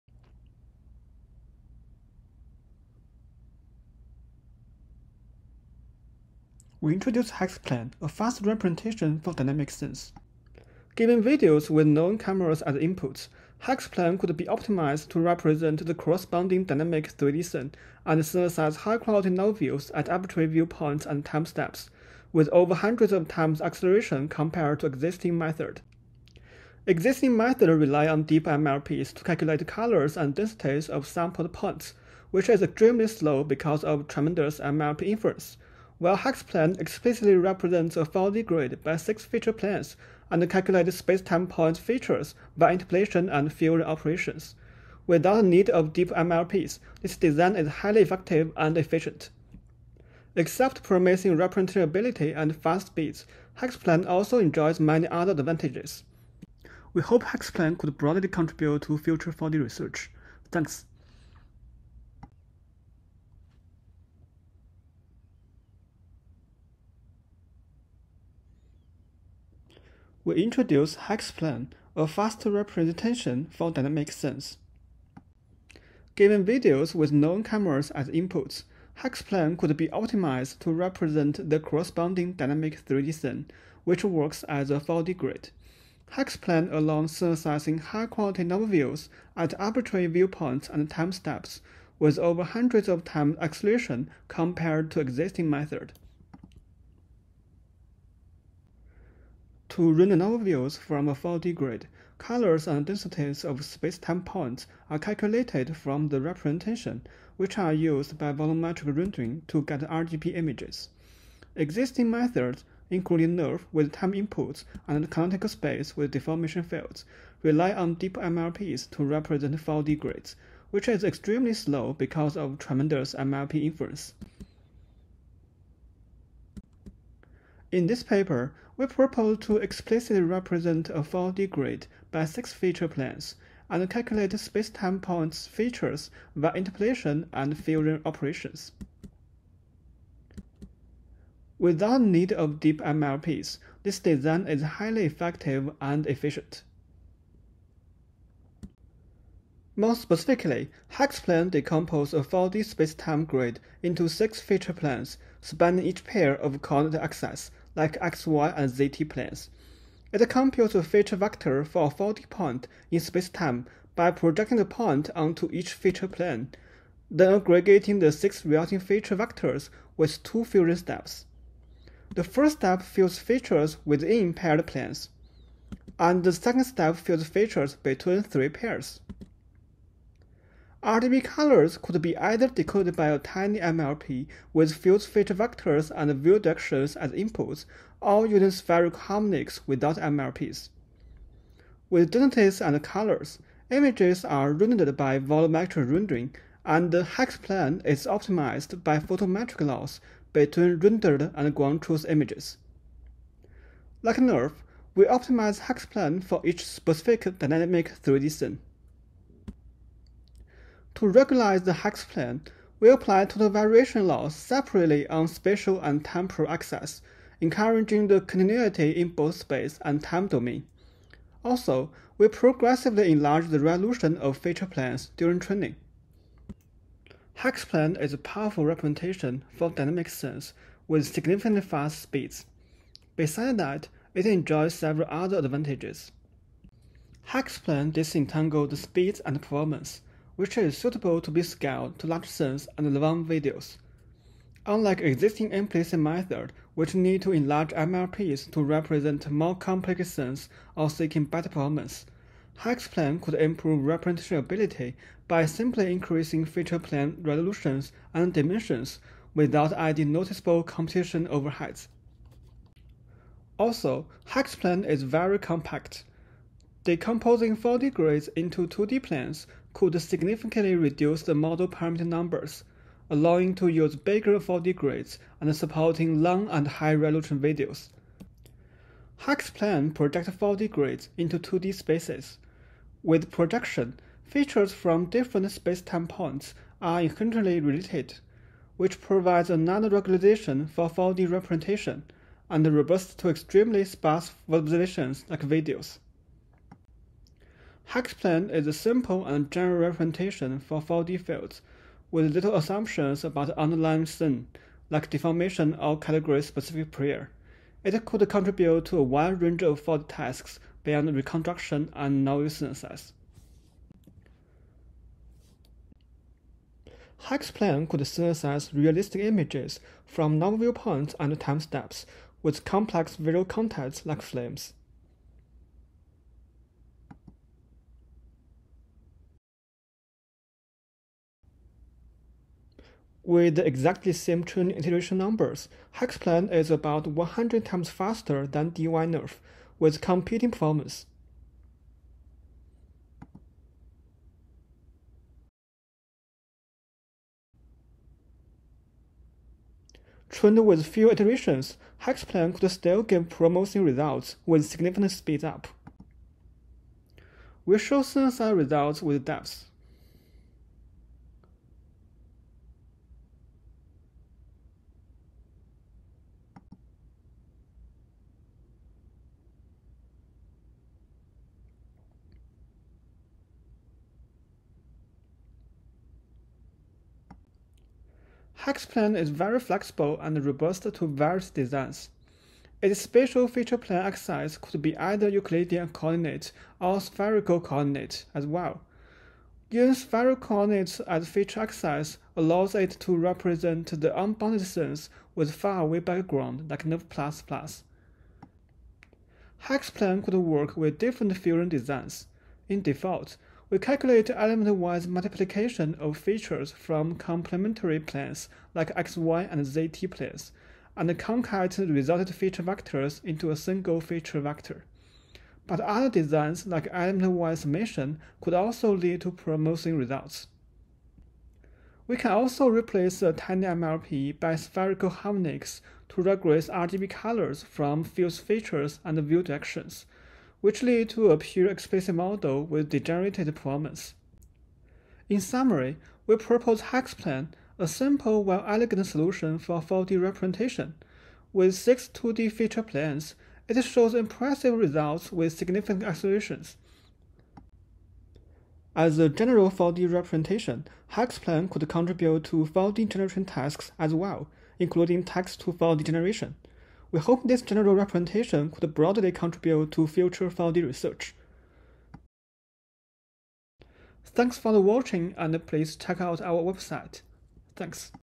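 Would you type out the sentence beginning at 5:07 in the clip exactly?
It could contribute to a wide range of 4D tasks beyond reconstruction and novel synthesis.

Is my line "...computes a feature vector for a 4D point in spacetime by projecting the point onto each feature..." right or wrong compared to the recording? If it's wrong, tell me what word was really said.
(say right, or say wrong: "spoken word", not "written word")
right.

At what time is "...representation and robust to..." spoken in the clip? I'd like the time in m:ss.
4:51.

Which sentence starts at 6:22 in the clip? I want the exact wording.
Its spatial feature plan axis could be either Euclidean coordinates or spherical coordinates as well.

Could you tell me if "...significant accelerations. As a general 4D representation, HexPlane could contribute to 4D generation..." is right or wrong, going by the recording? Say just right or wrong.
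right.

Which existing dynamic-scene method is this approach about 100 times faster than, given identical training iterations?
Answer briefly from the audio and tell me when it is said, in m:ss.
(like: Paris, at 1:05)
DyNeRF, at 5:38.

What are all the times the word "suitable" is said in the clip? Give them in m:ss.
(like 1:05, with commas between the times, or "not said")
4:00.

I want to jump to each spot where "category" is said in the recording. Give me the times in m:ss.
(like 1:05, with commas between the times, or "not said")
5:05.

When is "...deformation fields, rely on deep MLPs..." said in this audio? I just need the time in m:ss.
1:56.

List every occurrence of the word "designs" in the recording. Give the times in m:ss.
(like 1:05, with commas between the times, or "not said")
0:47, 2:23, 6:21, 6:41, 6:56.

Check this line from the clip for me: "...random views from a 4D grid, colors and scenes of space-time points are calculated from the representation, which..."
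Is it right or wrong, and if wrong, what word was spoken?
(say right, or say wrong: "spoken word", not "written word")
wrong: "densities", not "scenes".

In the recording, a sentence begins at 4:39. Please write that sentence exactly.
plan projects 4D grids into 2D spaces.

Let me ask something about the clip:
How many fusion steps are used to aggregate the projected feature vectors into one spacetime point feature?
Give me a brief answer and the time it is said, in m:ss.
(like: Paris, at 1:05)
2, at 2:50.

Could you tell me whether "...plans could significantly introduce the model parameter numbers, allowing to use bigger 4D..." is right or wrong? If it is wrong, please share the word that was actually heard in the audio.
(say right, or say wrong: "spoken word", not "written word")
wrong: "reduce", not "introduce".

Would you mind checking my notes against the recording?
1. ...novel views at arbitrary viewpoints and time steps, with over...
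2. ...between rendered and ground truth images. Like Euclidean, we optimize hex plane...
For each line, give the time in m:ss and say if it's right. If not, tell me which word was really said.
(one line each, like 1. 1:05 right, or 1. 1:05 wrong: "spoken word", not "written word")
1. 0:19 right
2. 3:20 wrong: "NeRF", not "Euclidean".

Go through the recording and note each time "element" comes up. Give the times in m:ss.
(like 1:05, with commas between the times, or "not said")
6:44, 6:56.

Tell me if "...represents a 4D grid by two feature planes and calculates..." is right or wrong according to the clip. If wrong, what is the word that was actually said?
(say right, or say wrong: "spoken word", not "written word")
wrong: "six", not "two".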